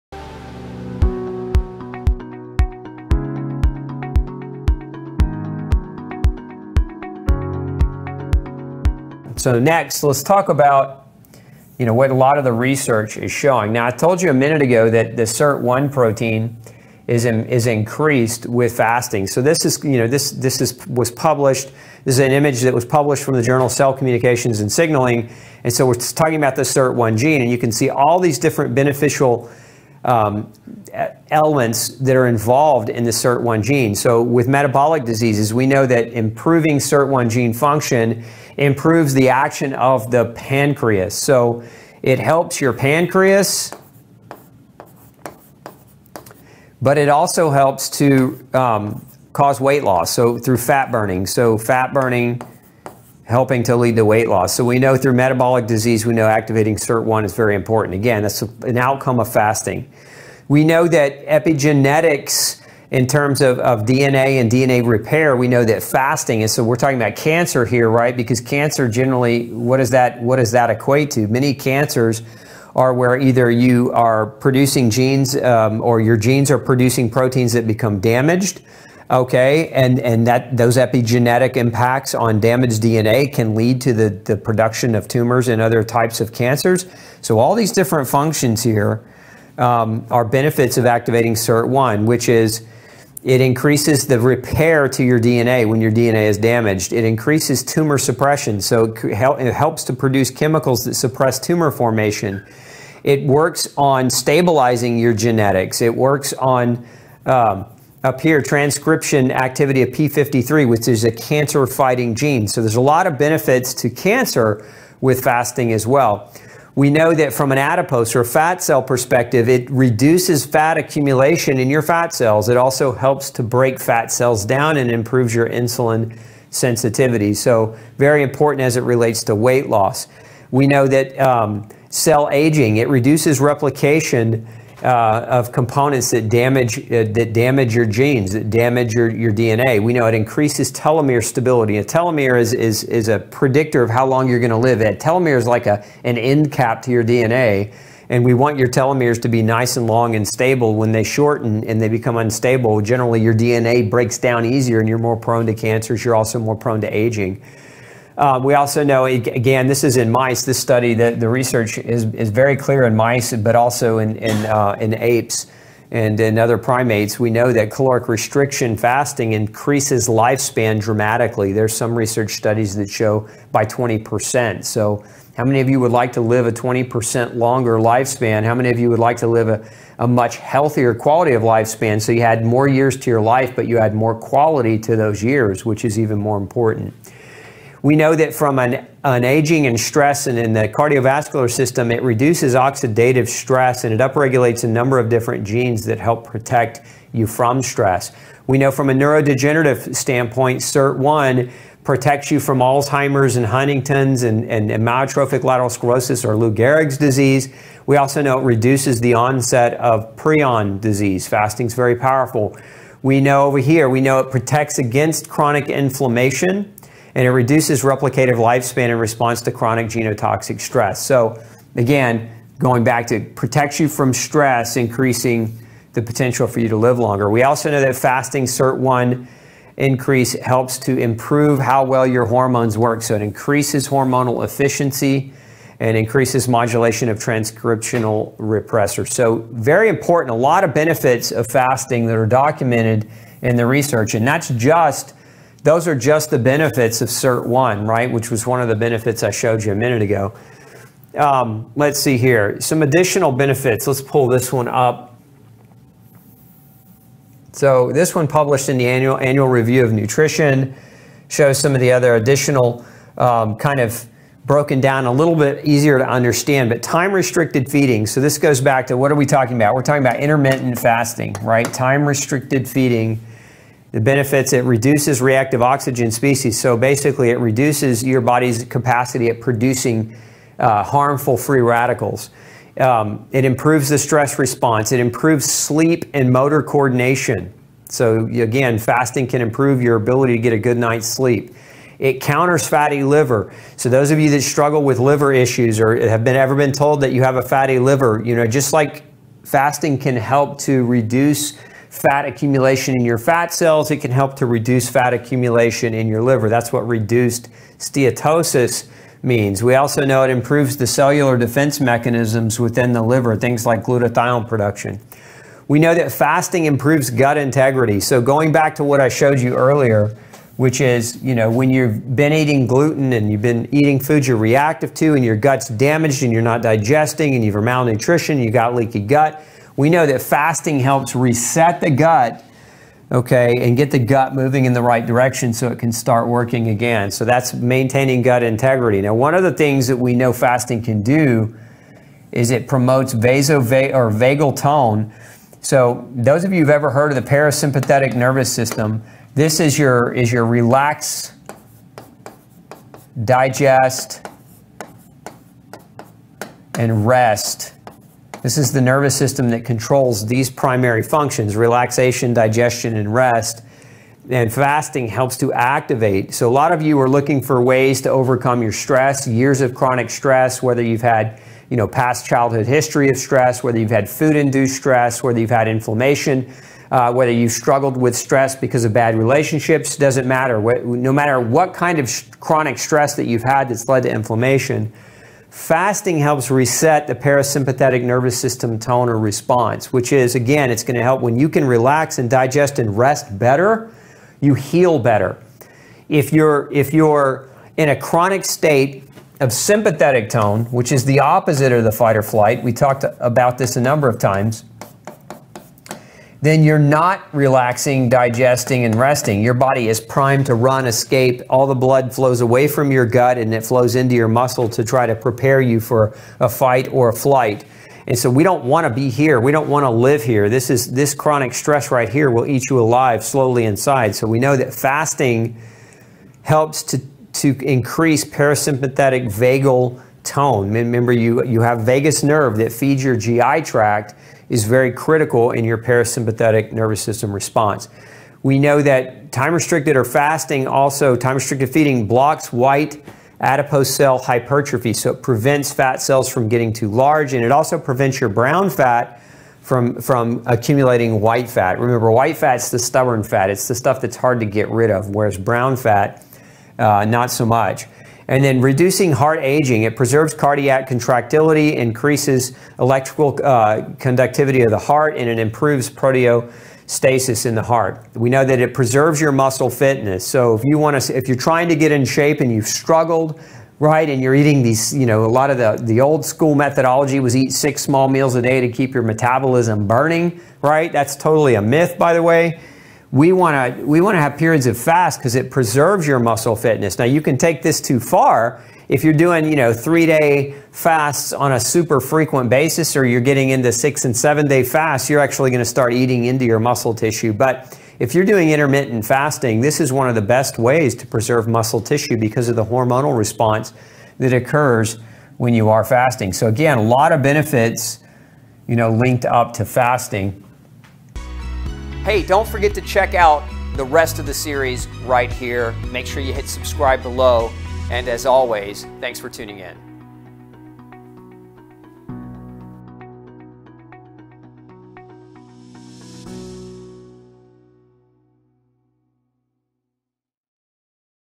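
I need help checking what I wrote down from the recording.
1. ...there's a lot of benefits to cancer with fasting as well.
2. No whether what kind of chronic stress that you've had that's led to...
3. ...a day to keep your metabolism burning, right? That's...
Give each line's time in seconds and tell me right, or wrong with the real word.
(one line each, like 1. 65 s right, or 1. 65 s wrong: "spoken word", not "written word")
1. 112 s right
2. 380 s wrong: "matter", not "whether"
3. 478 s right.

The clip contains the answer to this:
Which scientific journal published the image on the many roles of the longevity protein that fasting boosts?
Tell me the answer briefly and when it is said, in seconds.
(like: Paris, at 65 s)
Cell Communications and Signaling, at 23 s.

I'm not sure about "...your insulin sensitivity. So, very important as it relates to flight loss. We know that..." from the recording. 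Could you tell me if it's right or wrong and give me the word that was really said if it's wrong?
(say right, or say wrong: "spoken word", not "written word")
wrong: "weight", not "flight".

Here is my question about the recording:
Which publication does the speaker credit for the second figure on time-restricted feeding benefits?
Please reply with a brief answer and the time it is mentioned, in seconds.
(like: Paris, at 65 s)
Annual Review of Nutrition, at 259 s.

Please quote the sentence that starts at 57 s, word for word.
Again, that's an outcome of fasting.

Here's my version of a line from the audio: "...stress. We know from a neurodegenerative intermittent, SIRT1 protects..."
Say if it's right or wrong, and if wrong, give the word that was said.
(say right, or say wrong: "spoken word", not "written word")
wrong: "standpoint", not "intermittent".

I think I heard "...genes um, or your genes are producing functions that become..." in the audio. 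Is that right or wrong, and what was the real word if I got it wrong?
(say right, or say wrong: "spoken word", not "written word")
wrong: "proteins", not "functions".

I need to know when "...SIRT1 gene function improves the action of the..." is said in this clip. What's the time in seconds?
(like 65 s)
36 s.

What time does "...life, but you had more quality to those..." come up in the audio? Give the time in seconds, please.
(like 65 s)
183 s.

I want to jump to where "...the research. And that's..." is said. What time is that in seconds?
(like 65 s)
243 s.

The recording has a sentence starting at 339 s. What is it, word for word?
Now, one of the things that we know fasting can do is it promotes vaso or vagal tone.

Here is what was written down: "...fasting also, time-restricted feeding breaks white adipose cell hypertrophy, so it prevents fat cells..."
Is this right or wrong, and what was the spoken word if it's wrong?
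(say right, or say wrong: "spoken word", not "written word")
wrong: "blocks", not "breaks".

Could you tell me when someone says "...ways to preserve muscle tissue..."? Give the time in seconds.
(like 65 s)
500 s.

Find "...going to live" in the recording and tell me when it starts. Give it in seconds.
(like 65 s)
144 s.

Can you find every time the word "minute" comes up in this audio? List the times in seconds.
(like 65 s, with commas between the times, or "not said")
14 s, 249 s.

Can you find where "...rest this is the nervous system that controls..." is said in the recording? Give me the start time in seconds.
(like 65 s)
357 s.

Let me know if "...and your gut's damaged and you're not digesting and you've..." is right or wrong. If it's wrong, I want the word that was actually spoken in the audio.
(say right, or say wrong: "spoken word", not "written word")
right.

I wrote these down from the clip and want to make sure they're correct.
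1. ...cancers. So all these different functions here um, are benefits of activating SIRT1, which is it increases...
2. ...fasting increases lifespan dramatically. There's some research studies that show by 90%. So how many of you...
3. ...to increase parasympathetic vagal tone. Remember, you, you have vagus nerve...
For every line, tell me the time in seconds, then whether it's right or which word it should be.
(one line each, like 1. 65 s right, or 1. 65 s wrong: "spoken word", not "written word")
1. 86 s right
2. 168 s wrong: "20", not "90"
3. 427 s right.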